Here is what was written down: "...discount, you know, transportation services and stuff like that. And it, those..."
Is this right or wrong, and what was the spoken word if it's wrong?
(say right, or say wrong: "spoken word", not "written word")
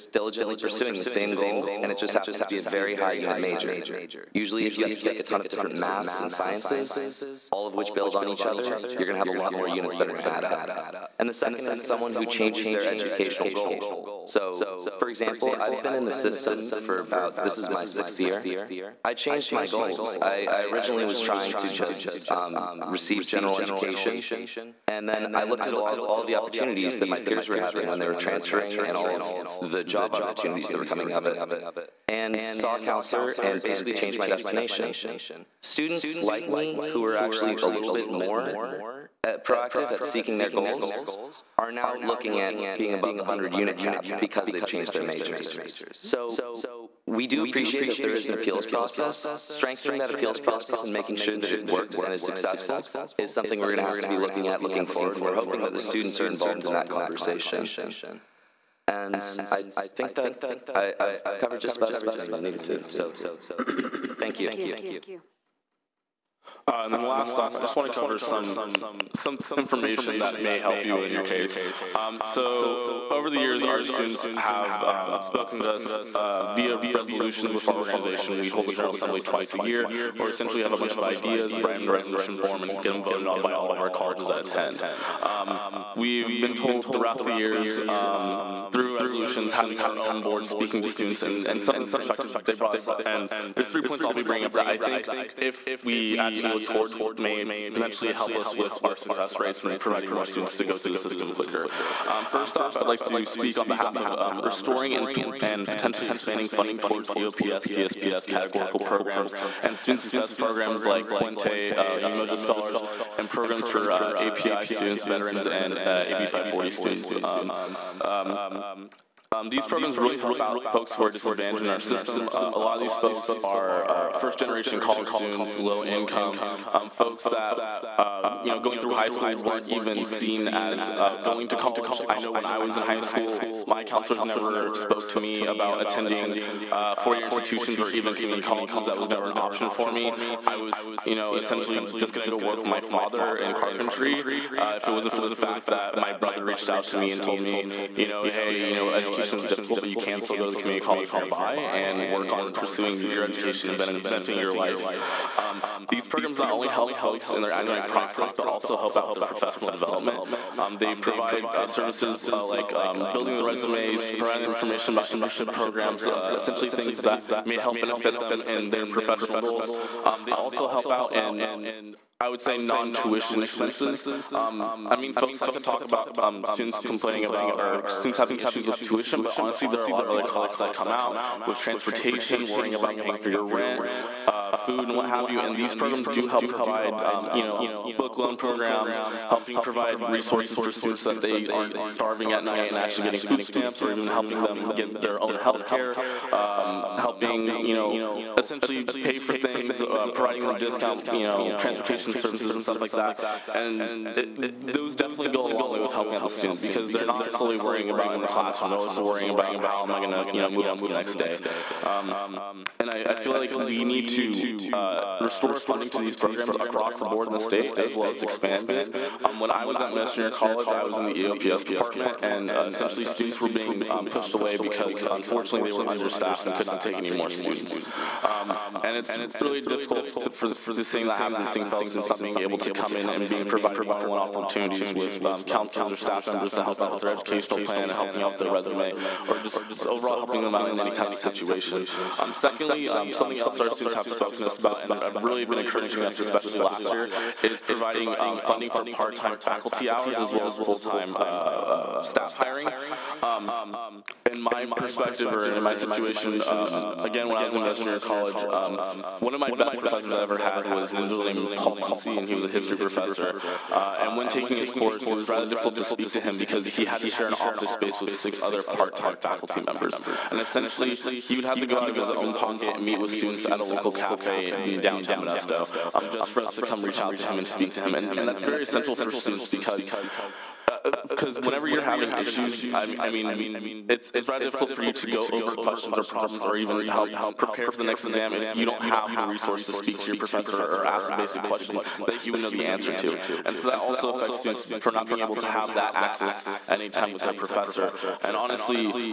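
right.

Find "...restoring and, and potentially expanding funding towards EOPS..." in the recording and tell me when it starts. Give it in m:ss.
1:44.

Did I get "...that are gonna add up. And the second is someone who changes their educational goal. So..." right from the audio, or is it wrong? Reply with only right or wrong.
right.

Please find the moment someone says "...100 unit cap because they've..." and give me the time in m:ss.
0:43.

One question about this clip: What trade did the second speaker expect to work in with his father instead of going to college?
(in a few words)
carpentry.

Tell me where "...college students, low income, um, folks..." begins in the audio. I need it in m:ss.
2:04.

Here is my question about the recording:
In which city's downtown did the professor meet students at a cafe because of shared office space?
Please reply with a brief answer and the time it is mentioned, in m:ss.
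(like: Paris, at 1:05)
Modesto, at 4:35.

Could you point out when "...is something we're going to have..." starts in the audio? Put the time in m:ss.
0:53.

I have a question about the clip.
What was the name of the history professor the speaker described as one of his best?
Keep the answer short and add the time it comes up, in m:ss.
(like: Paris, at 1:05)
Paul Muncie, at 4:21.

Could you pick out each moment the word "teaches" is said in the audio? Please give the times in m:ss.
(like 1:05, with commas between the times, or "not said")
not said.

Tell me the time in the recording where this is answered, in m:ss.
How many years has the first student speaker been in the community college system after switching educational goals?
0:17.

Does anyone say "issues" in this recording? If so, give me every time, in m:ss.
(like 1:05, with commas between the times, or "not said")
2:58, 4:42.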